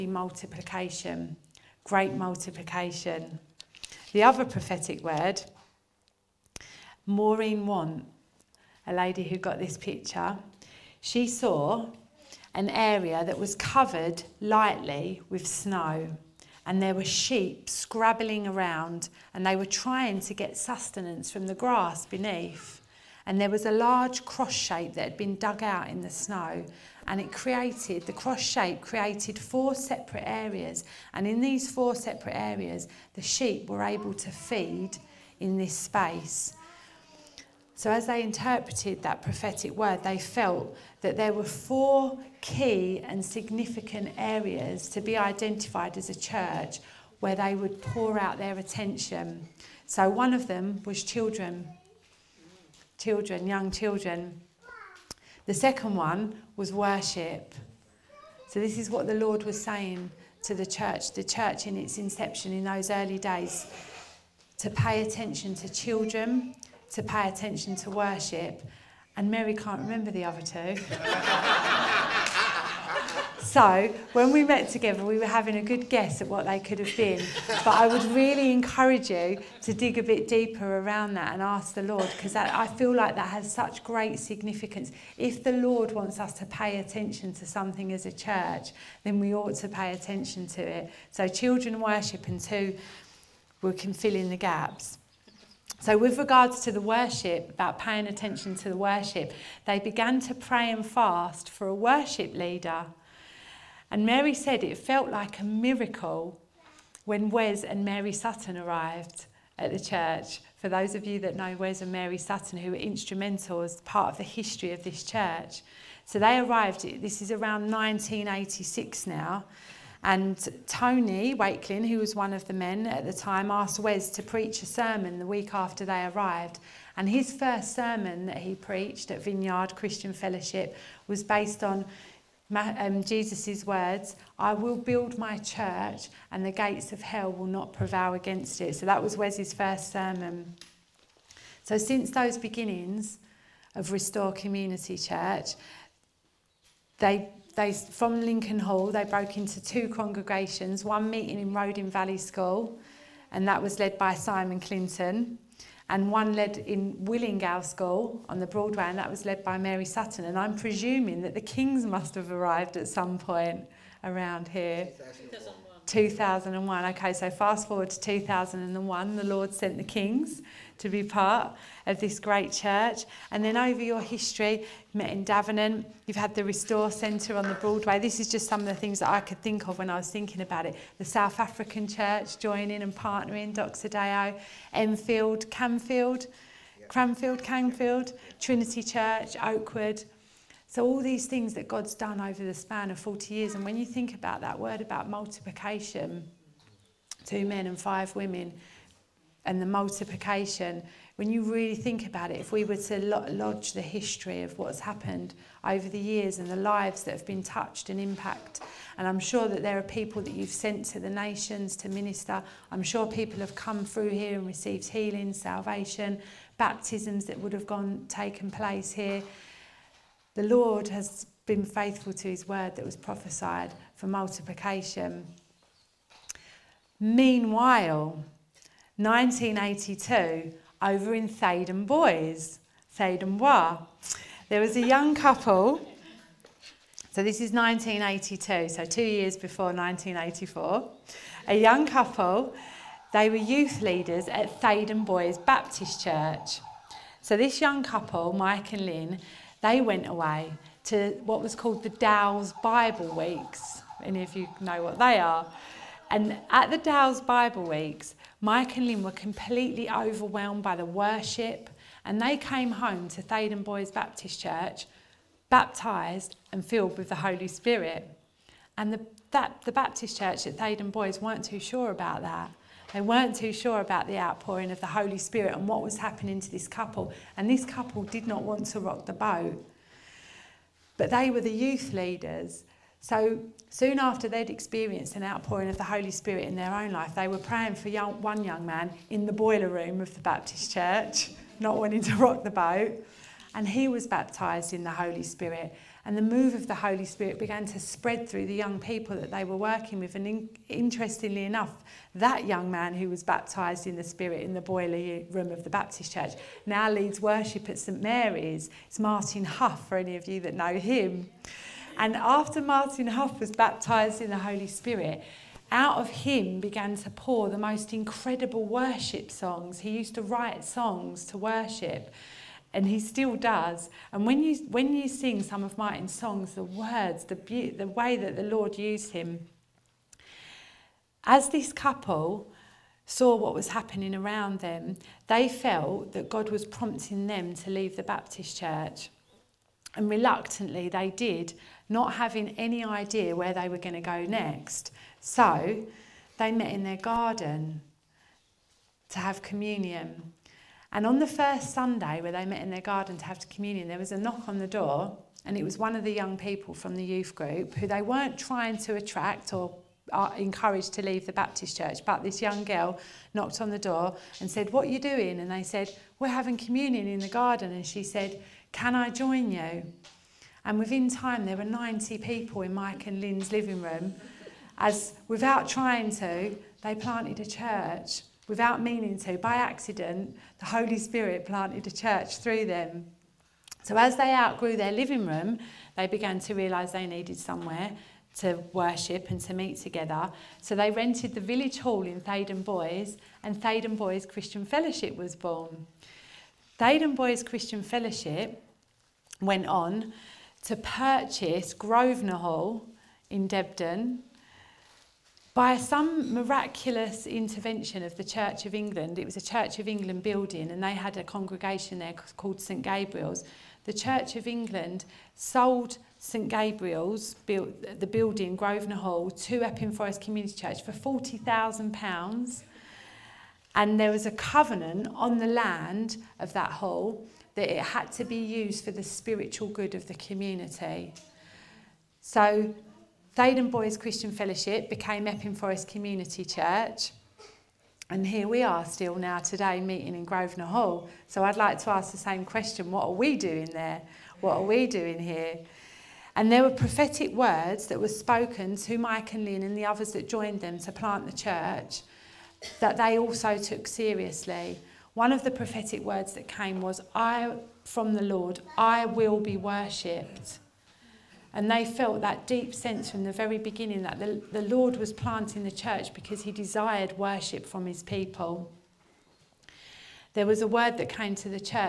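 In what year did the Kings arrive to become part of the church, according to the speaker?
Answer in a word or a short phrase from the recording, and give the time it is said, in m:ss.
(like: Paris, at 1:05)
2001, at 2:44.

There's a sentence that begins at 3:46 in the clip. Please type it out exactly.
Meanwhile, 1982 over in Theydon Bois, Theydon Bois, There was a young couple, so this is 1982, so two years before 1984.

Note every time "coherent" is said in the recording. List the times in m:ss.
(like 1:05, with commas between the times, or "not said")
not said.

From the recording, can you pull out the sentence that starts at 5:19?
He used to write songs to worship, and he still does.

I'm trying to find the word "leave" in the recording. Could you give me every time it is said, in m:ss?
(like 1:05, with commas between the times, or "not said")
5:37, 6:01.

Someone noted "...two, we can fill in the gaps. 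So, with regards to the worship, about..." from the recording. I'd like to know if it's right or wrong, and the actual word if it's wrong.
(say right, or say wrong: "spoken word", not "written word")
right.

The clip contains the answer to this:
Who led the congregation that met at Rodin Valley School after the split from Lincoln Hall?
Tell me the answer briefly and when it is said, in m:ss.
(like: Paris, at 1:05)
Simon Clinton, at 2:34.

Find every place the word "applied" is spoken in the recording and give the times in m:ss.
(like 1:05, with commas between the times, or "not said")
not said.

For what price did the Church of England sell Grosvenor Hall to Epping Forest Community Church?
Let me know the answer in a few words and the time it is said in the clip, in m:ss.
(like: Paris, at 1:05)
£40,000, at 7:00.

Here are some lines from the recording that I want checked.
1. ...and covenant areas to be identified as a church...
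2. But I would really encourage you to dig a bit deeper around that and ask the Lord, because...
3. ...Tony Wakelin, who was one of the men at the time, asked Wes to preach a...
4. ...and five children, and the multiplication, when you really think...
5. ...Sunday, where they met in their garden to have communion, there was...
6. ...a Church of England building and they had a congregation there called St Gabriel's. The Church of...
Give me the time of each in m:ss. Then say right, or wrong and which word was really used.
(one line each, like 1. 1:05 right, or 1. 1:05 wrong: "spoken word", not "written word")
1. 0:43 wrong: "significant", not "covenant"
2. 1:17 right
3. 2:00 right
4. 3:17 wrong: "women", not "children"
5. 5:51 right
6. 6:49 right.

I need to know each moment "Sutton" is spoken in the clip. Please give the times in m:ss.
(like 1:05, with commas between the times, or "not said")
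1:48, 1:52, 2:39.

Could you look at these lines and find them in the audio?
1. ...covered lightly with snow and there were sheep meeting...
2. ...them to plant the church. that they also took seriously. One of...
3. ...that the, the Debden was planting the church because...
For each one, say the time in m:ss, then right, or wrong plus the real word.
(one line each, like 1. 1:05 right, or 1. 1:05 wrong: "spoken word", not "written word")
1. 0:13 wrong: "scrabbling", not "meeting"
2. 7:30 right
3. 7:44 wrong: "Lord", not "Debden".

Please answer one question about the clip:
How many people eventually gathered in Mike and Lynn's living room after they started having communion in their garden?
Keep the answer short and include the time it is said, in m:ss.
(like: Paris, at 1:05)
90, at 6:11.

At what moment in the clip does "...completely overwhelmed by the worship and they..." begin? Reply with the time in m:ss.
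4:19.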